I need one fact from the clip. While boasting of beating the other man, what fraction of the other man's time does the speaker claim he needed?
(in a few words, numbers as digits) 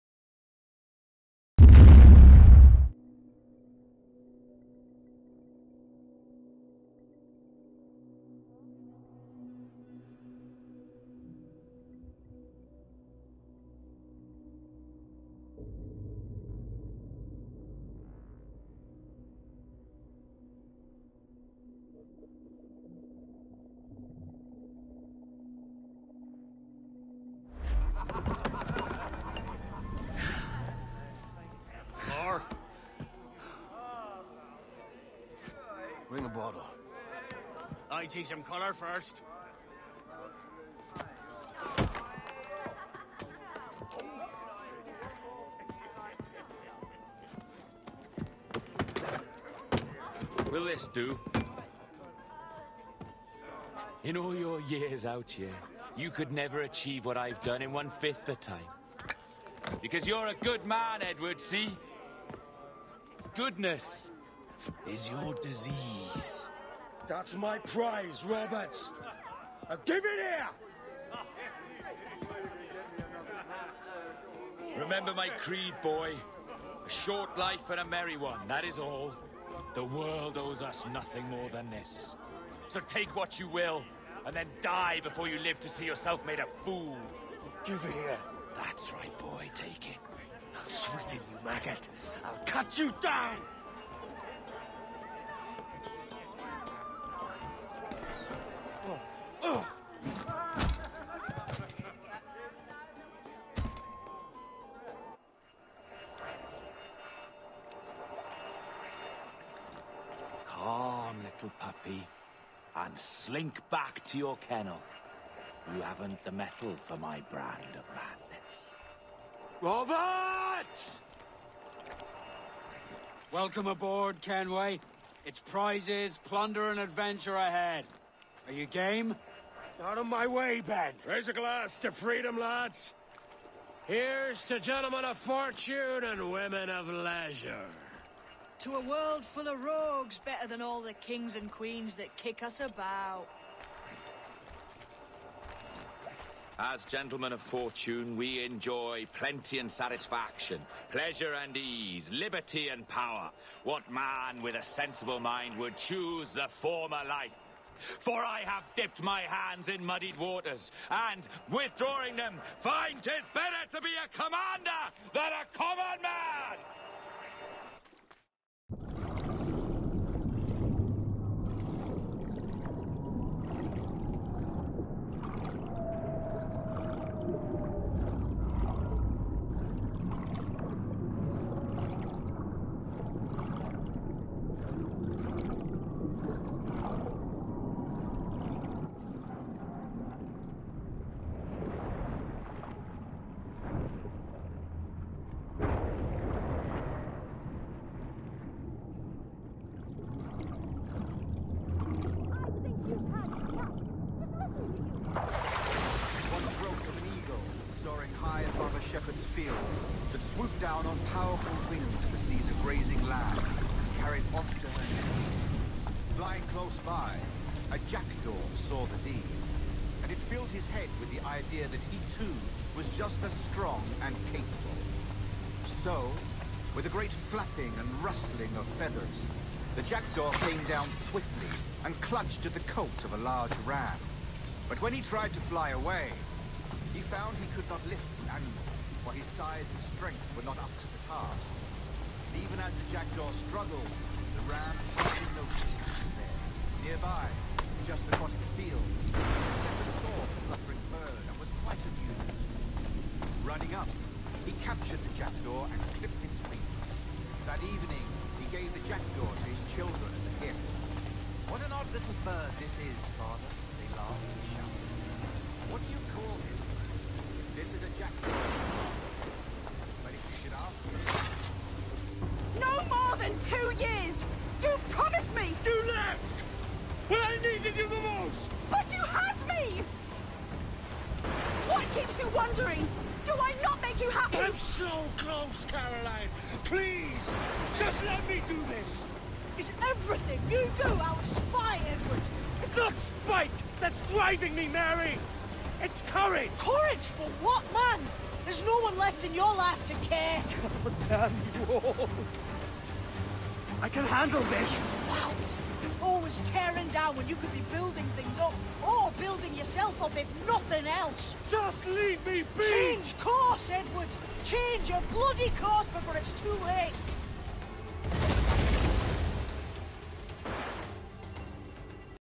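One-fifth.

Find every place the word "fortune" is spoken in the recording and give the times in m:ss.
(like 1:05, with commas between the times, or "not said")
2:15, 2:27.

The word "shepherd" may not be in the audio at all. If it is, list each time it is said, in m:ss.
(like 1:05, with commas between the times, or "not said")
3:28, 4:09.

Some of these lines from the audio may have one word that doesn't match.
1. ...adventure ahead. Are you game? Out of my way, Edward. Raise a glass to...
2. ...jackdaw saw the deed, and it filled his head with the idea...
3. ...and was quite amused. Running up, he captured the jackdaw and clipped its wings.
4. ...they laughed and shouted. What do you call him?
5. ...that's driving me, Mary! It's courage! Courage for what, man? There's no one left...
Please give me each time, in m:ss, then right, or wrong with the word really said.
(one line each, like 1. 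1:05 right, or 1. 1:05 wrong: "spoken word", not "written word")
1. 2:06 wrong: "Ben", not "Edward"
2. 3:37 right
3. 4:11 right
4. 4:23 right
5. 4:53 right.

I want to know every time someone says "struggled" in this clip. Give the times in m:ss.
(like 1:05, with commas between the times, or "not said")
4:03.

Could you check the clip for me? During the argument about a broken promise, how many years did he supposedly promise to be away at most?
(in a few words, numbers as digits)
2 years.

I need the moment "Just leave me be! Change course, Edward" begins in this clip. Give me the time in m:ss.
5:11.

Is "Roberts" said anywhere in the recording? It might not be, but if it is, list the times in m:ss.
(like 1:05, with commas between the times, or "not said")
1:08, 1:59.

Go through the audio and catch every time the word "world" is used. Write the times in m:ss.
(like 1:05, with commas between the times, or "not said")
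1:19, 2:18.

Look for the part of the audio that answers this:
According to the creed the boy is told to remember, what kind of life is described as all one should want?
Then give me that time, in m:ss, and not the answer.
1:16.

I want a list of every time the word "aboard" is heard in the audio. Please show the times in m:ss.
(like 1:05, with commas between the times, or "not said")
2:03.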